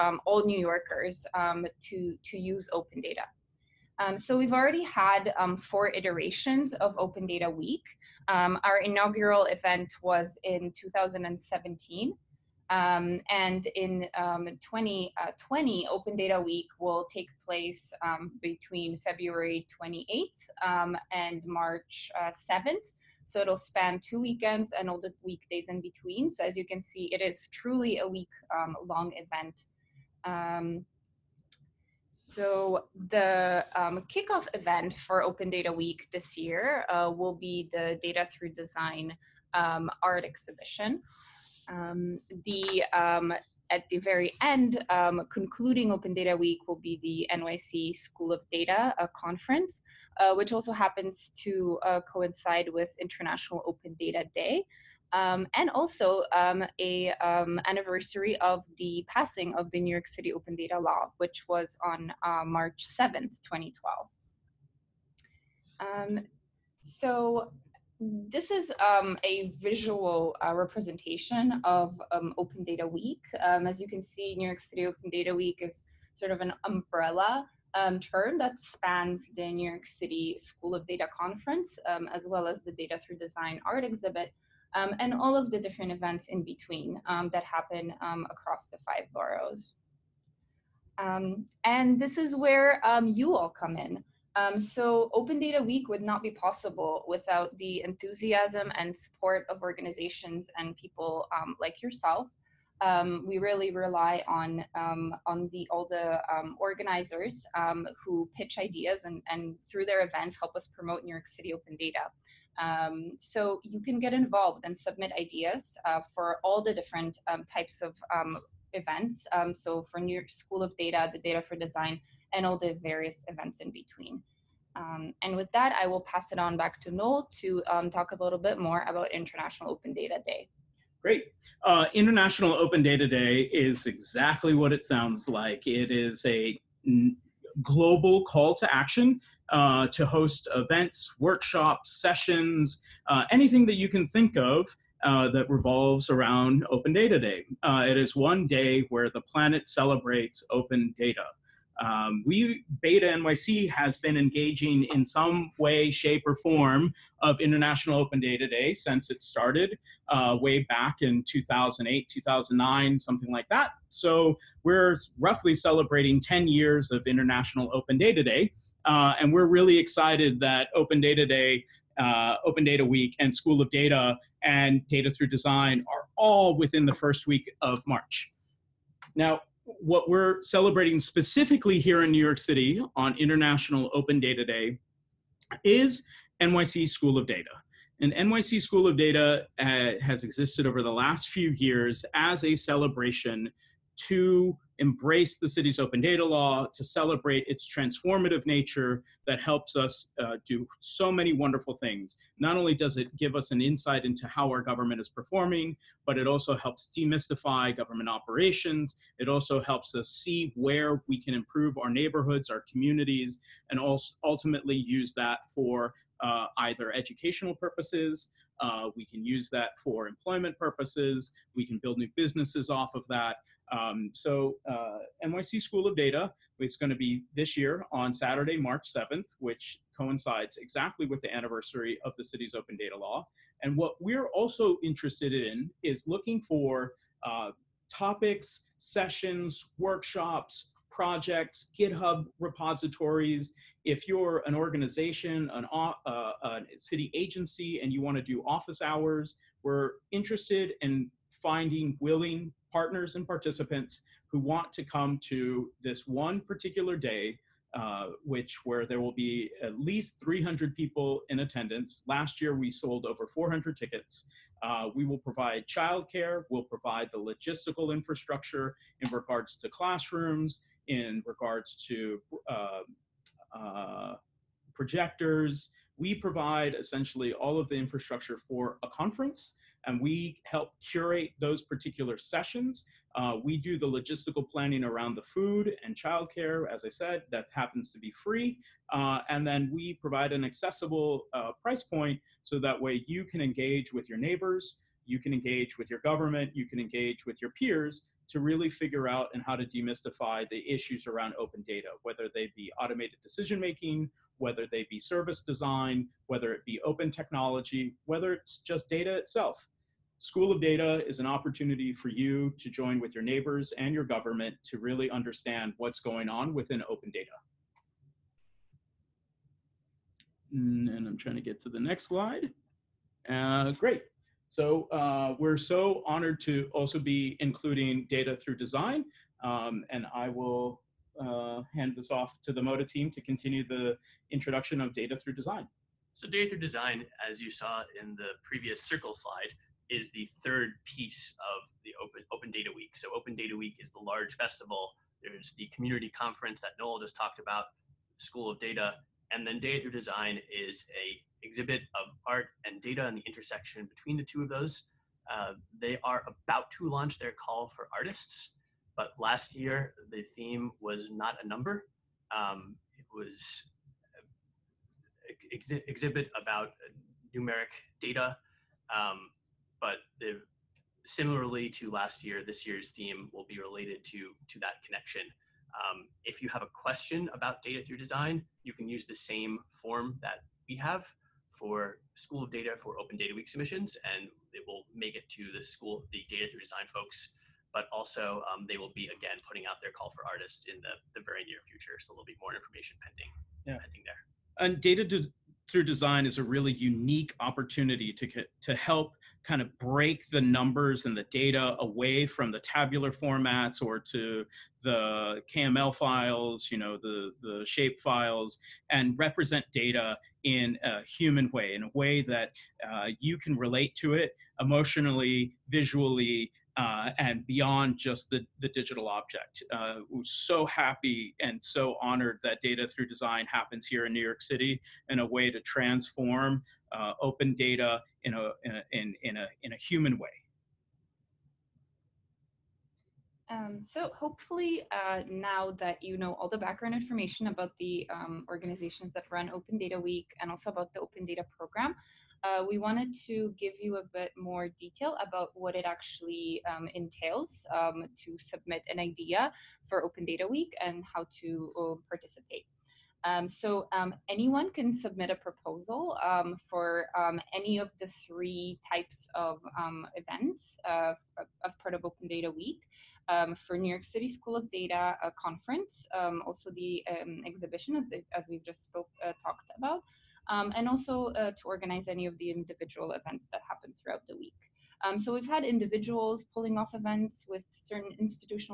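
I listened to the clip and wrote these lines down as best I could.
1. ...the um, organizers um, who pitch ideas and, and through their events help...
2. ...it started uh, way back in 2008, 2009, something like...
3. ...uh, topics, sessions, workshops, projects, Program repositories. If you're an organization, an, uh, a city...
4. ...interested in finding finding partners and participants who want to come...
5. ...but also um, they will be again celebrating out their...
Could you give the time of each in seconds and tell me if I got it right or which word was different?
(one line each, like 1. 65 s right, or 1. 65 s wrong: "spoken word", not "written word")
1. 105 s right
2. 159 s right
3. 237 s wrong: "GitHub", not "Program"
4. 250 s wrong: "willing", not "finding"
5. 387 s wrong: "putting", not "celebrating".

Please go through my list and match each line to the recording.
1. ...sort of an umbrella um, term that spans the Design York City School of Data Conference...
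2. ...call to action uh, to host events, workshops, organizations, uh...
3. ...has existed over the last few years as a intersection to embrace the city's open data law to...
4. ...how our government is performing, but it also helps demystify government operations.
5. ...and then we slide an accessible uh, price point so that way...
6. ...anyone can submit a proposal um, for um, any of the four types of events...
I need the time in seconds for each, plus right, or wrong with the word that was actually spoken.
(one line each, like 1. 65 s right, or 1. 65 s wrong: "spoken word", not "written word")
1. 76 s wrong: "New", not "Design"
2. 138 s wrong: "sessions", not "organizations"
3. 190 s wrong: "celebration", not "intersection"
4. 204 s right
5. 289 s wrong: "provide", not "slide"
6. 454 s wrong: "three", not "four".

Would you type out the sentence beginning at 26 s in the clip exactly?
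So as you can see, it is truly a week um, long event.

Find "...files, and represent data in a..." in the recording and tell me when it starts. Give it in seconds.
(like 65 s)
407 s.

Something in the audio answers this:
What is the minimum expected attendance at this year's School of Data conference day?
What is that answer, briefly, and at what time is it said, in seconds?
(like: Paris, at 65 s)
300 people, at 260 s.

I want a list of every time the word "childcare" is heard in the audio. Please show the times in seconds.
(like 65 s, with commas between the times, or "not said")
265 s, 285 s.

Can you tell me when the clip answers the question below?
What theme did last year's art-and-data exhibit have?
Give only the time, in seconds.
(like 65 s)
361 s.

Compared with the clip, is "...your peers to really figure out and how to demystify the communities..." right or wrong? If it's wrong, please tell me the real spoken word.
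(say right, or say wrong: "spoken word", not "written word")
wrong: "issues", not "communities".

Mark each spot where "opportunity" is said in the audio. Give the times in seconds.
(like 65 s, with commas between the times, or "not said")
311 s, 397 s.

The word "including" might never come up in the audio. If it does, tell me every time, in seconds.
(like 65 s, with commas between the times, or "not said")
327 s.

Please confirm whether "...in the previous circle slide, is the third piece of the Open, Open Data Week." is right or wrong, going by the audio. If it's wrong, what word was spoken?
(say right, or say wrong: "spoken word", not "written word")
right.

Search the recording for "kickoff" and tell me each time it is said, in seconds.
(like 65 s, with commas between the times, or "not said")
34 s.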